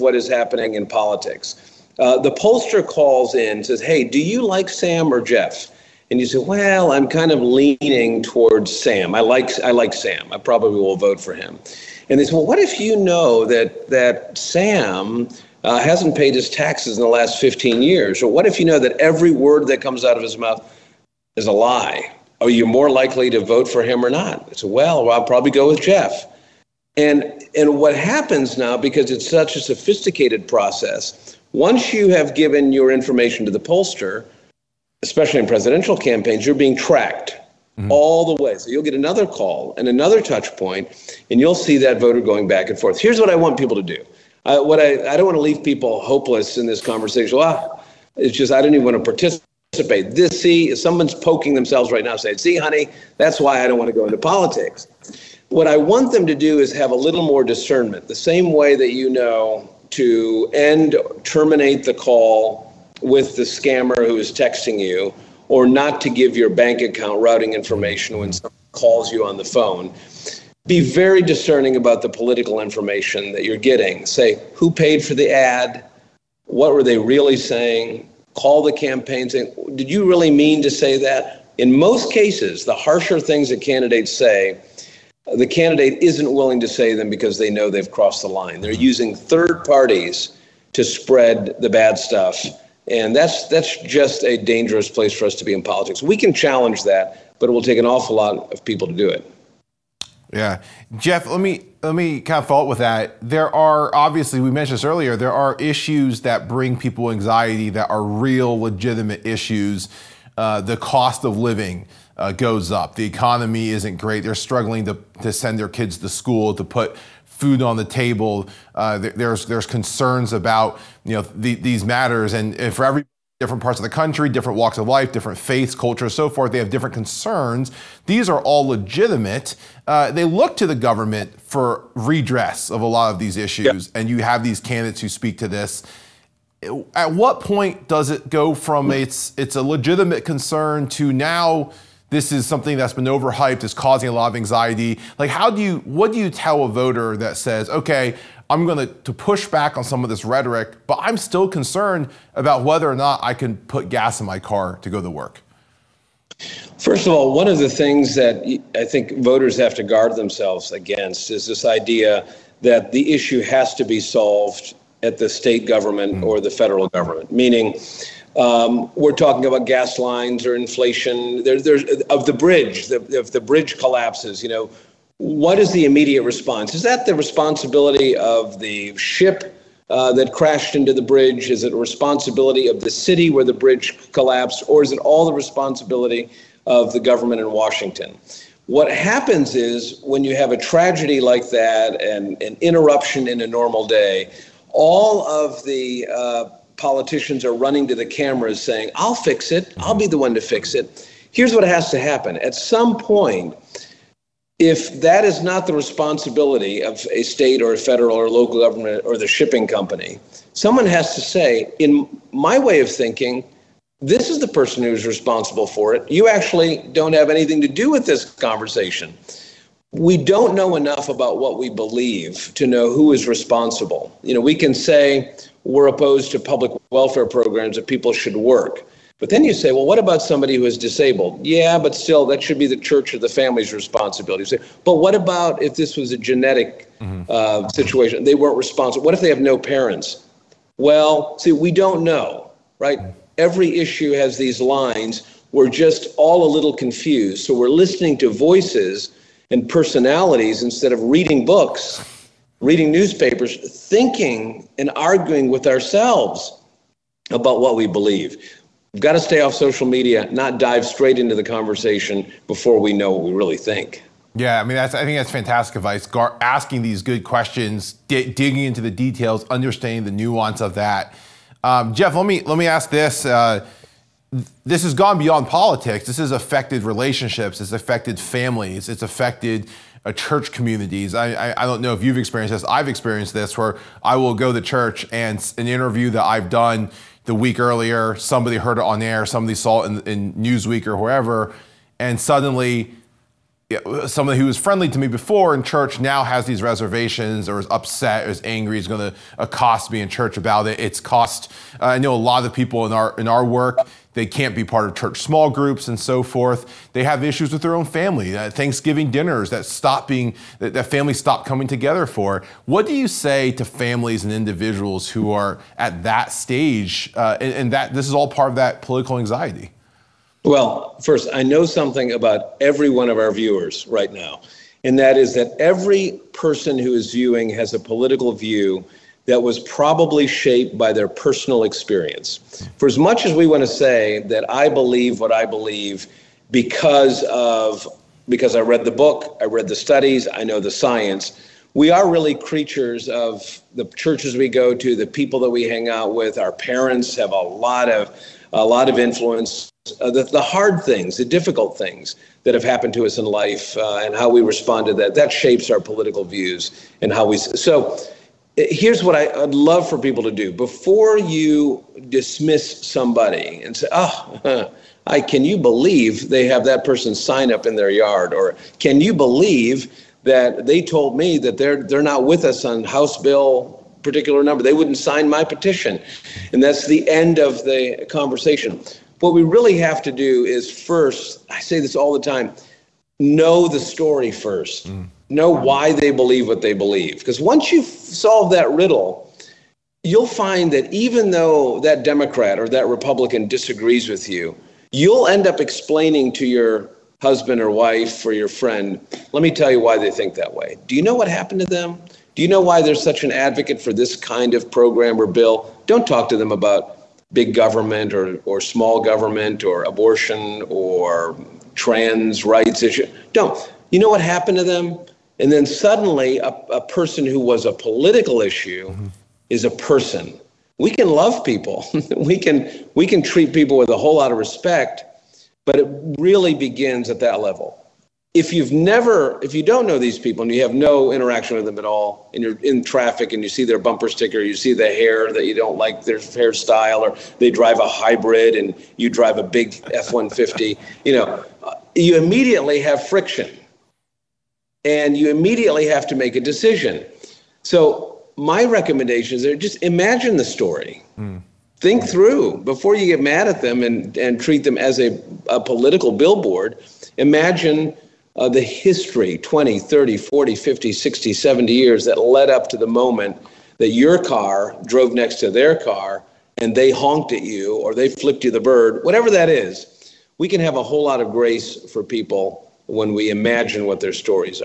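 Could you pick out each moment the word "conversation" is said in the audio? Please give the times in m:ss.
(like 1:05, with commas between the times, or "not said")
0:46, 3:38, 4:21, 6:18.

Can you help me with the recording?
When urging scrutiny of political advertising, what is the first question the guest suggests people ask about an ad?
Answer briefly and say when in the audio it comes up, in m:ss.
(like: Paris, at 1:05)
Who paid for the ad?, at 1:14.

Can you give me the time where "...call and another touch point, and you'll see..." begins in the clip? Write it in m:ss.
0:39.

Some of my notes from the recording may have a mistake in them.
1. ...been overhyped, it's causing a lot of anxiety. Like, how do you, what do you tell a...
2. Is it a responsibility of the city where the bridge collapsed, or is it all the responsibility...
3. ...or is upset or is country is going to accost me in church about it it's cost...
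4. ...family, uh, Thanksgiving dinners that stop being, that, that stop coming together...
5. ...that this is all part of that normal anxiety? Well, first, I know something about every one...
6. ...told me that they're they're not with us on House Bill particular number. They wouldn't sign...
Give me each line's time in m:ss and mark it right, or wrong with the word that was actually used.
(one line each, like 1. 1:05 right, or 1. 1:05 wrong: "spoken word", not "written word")
1. 2:22 right
2. 3:01 right
3. 4:57 wrong: "angry", not "country"
4. 5:07 right
5. 5:17 wrong: "political", not "normal"
6. 6:10 right.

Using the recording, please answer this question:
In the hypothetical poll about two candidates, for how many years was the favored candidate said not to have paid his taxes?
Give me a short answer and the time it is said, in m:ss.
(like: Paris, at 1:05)
15, at 0:17.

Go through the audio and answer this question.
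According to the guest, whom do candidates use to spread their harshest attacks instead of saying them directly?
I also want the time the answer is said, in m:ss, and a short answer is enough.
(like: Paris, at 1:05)
Third parties, at 1:29.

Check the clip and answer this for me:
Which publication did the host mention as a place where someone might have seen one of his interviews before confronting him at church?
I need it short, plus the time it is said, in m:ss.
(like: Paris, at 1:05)
Newsweek, at 4:50.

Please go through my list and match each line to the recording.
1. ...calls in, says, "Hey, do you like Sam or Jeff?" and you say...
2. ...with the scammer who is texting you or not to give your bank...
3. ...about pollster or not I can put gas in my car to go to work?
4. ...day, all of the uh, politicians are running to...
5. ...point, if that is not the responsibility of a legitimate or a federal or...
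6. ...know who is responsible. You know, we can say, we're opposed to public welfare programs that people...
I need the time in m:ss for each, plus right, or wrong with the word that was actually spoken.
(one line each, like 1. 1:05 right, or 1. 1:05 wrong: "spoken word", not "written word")
1. 0:02 right
2. 1:03 right
3. 2:32 wrong: "whether", not "pollster"
4. 3:13 right
5. 3:22 wrong: "state", not "legitimate"
6. 3:42 right.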